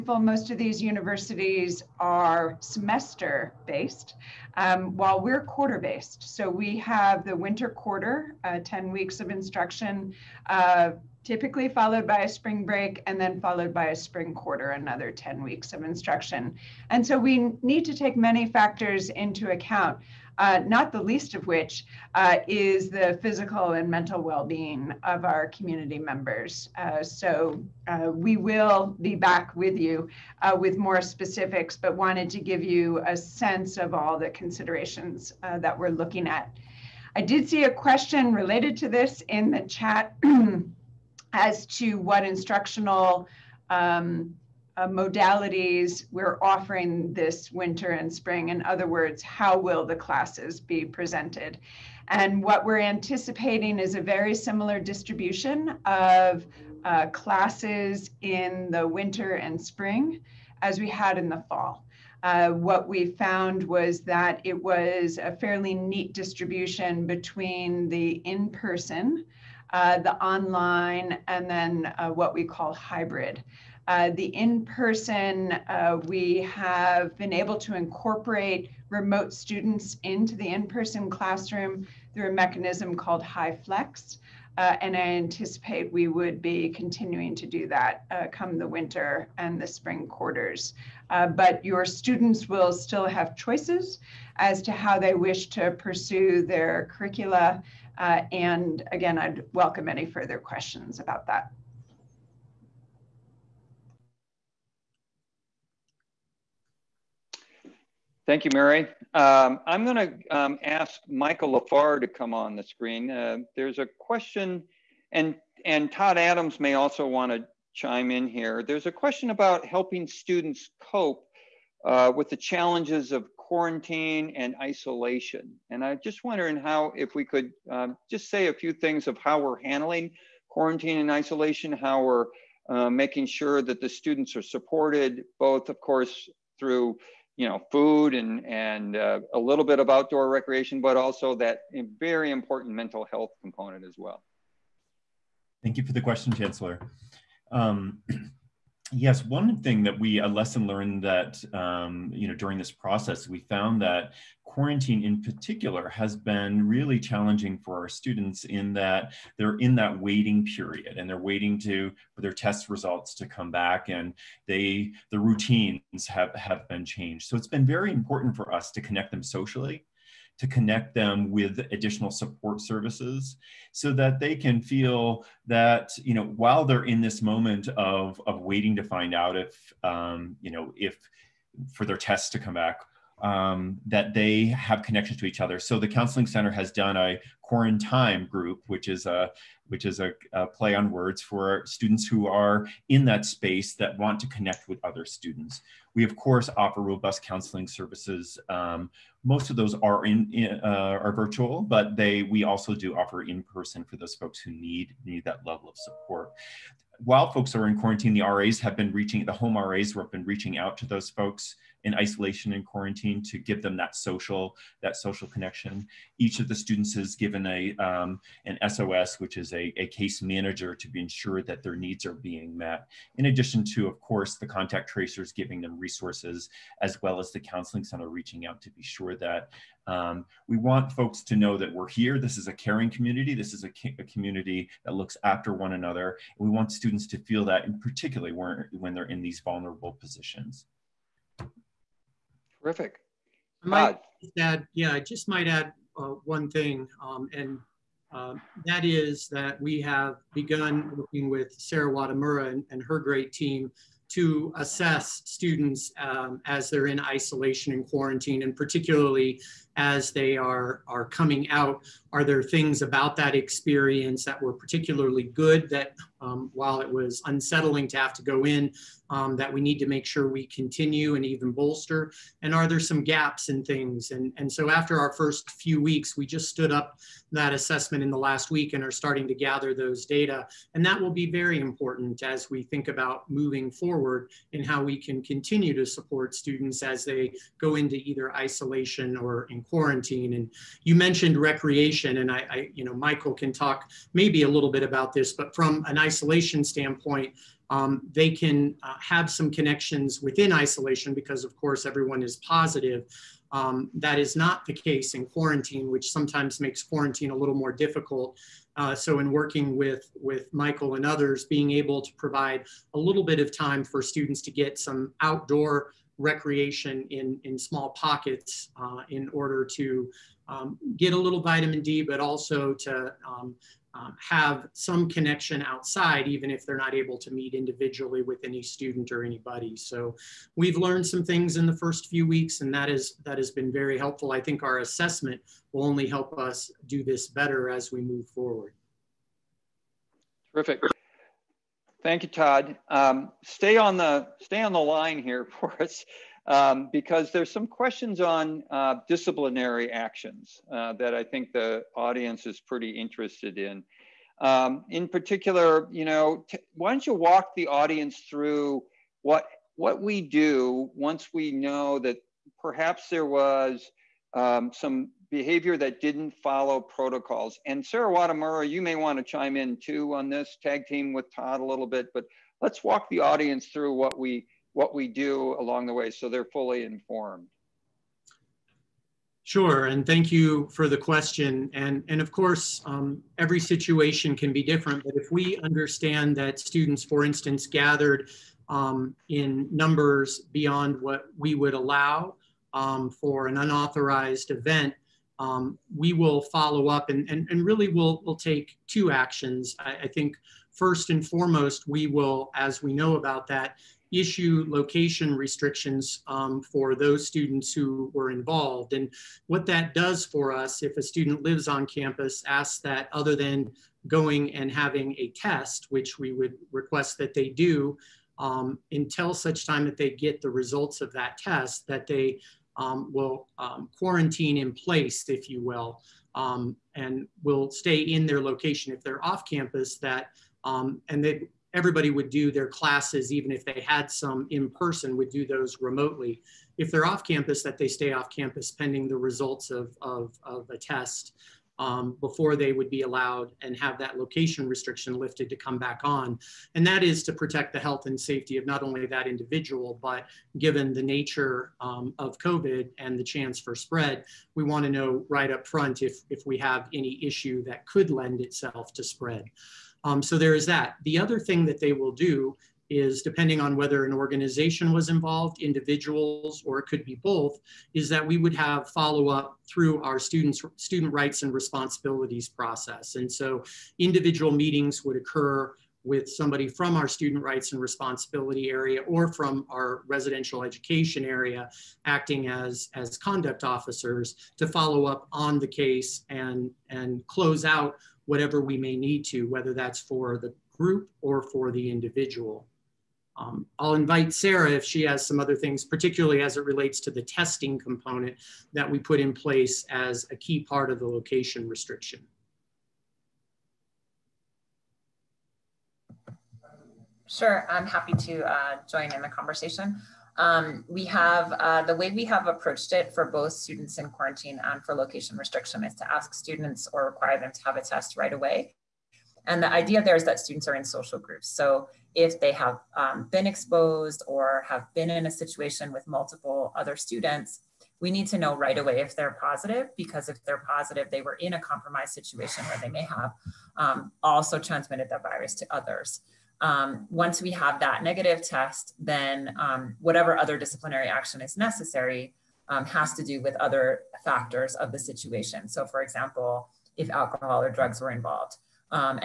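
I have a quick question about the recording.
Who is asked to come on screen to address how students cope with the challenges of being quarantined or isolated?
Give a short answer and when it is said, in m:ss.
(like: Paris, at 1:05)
Michael Lafar, at 1:51.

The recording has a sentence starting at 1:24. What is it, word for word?
Uh, and I anticipate we would be continuing to do that uh, come the winter and the spring quarters.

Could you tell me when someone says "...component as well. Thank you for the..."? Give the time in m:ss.
2:23.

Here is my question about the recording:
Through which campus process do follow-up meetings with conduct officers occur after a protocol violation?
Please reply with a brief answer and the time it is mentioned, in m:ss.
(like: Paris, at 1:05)
student rights and responsibilities, at 7:50.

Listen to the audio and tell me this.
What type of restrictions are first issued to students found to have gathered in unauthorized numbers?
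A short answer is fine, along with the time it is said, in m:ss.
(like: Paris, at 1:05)
location restrictions, at 6:44.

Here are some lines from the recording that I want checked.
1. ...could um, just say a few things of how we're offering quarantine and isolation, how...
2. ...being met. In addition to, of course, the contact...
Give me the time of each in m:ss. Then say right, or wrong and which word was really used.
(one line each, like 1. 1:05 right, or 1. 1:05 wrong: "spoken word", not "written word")
1. 2:07 wrong: "handling", not "offering"
2. 3:42 right.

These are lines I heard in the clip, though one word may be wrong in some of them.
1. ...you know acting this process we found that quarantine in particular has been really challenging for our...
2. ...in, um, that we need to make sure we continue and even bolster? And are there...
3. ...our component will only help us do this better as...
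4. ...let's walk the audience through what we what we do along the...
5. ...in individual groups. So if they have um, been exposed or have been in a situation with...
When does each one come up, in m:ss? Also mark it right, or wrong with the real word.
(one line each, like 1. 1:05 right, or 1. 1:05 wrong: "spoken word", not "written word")
1. 2:32 wrong: "during", not "acting"
2. 4:28 right
3. 5:34 wrong: "assessment", not "component"
4. 6:12 right
5. 8:40 wrong: "social", not "individual".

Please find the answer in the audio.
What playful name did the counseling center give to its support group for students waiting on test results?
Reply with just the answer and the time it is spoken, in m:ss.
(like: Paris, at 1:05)
quarantine group, at 3:07.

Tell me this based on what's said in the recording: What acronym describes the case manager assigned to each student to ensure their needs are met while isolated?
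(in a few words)
SOS.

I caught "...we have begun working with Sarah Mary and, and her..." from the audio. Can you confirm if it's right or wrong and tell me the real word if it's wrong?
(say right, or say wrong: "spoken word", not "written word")
wrong: "Watamura", not "Mary".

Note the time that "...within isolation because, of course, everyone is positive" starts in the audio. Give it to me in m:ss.
5:00.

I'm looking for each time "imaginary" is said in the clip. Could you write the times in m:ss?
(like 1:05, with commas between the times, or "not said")
not said.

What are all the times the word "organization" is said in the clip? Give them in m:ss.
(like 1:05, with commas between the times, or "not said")
7:44.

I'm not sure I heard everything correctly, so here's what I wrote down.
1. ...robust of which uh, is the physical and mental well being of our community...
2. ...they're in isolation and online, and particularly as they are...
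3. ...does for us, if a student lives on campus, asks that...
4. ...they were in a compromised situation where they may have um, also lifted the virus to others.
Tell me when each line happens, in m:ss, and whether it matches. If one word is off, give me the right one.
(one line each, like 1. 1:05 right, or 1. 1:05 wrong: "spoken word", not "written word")
1. 0:21 wrong: "least", not "robust"
2. 4:16 wrong: "quarantine", not "online"
3. 6:49 right
4. 8:51 wrong: "transmitted", not "lifted".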